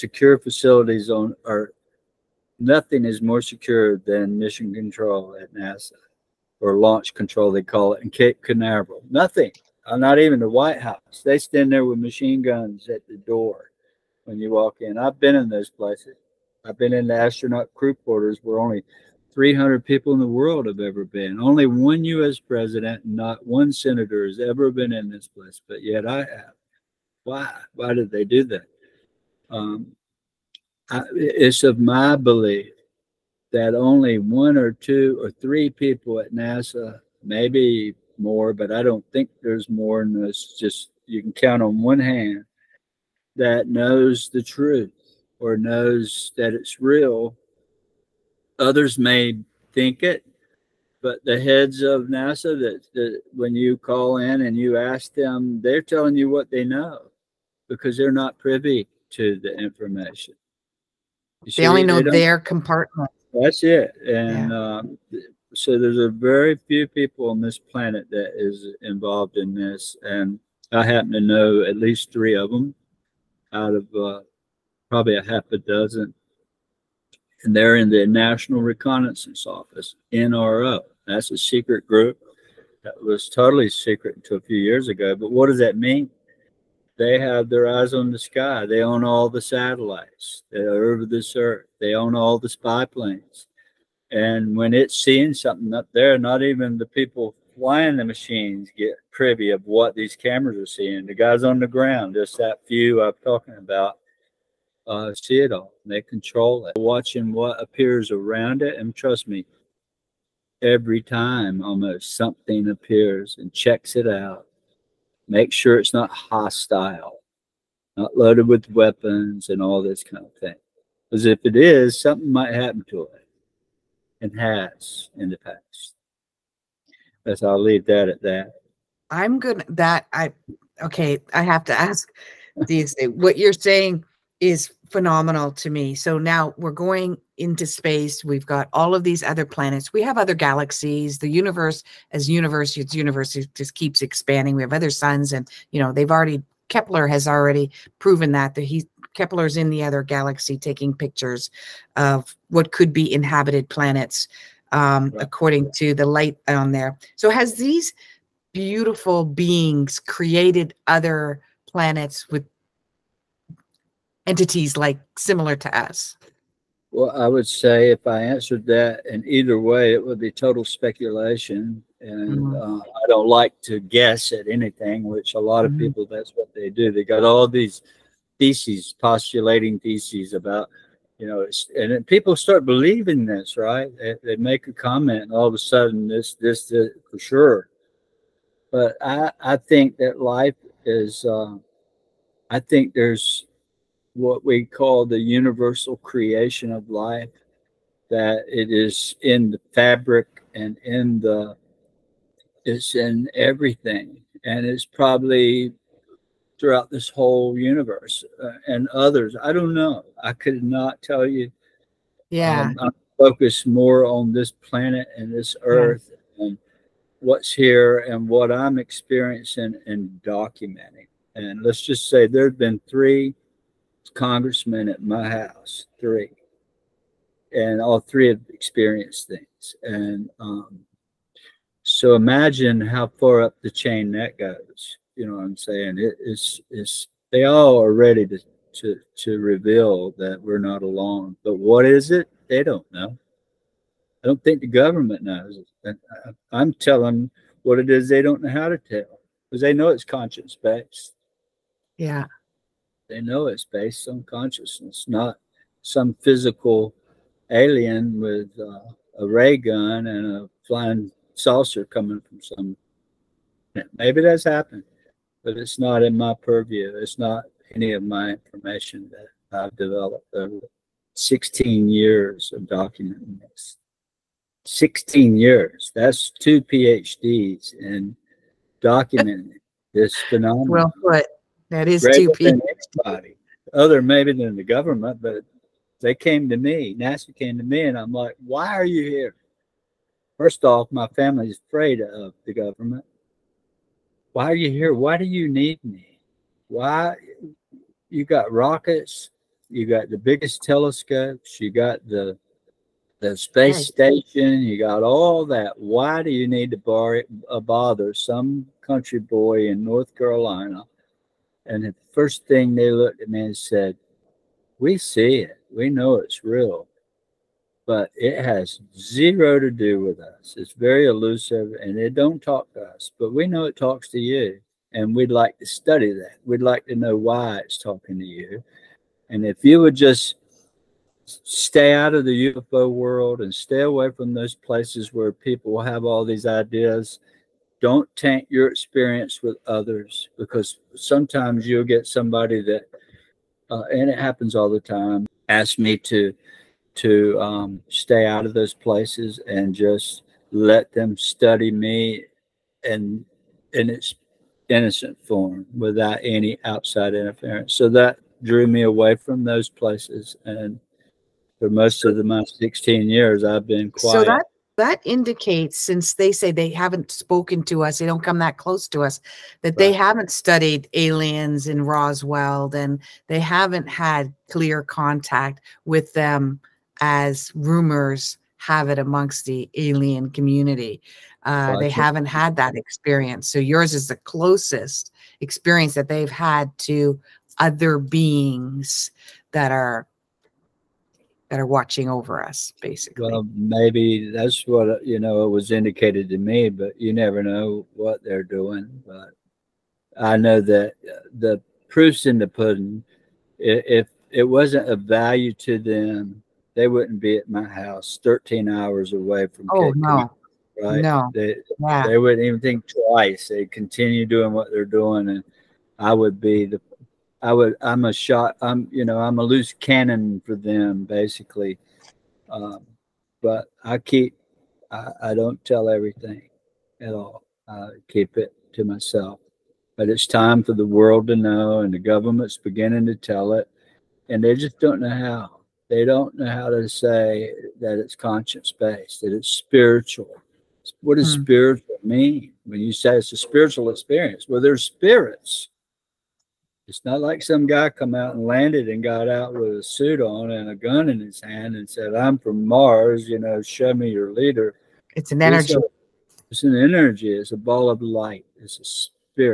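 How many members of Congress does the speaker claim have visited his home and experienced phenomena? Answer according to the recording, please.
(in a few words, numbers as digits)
3.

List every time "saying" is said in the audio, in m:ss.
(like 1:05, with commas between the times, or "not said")
2:13, 3:55.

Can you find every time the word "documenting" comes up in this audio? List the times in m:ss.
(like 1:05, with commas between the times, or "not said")
3:40, 4:32, 4:38.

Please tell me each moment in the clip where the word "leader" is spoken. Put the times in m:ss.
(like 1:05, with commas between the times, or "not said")
7:34.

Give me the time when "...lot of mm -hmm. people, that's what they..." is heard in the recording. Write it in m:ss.
2:55.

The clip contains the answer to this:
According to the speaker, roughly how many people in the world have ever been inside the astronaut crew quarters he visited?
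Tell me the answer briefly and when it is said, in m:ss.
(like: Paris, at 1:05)
300, at 0:19.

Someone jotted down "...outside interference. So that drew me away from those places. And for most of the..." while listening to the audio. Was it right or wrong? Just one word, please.
right.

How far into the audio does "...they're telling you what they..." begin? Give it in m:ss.
0:55.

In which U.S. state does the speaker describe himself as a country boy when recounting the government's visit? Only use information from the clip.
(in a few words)
North Carolina.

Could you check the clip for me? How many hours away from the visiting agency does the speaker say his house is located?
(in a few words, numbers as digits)
13.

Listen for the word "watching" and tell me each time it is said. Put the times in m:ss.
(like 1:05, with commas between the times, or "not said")
1:46, 6:31.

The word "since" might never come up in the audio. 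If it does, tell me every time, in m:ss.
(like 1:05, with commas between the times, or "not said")
6:05.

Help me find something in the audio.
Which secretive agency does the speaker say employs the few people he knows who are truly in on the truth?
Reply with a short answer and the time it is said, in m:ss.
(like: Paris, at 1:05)
National Reconnaissance Office, at 1:18.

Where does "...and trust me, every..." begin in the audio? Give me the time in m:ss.
1:48.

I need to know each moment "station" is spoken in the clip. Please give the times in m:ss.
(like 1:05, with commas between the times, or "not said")
5:03.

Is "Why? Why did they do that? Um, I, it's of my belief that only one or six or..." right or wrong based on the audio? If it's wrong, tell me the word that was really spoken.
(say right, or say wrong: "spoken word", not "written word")
wrong: "two", not "six".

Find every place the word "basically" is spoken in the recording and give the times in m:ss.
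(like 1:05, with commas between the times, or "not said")
6:32, 7:01.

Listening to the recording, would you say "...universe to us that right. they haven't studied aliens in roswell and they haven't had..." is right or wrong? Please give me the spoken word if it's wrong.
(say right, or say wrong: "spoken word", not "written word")
wrong: "close", not "universe".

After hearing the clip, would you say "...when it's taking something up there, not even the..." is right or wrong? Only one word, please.
wrong.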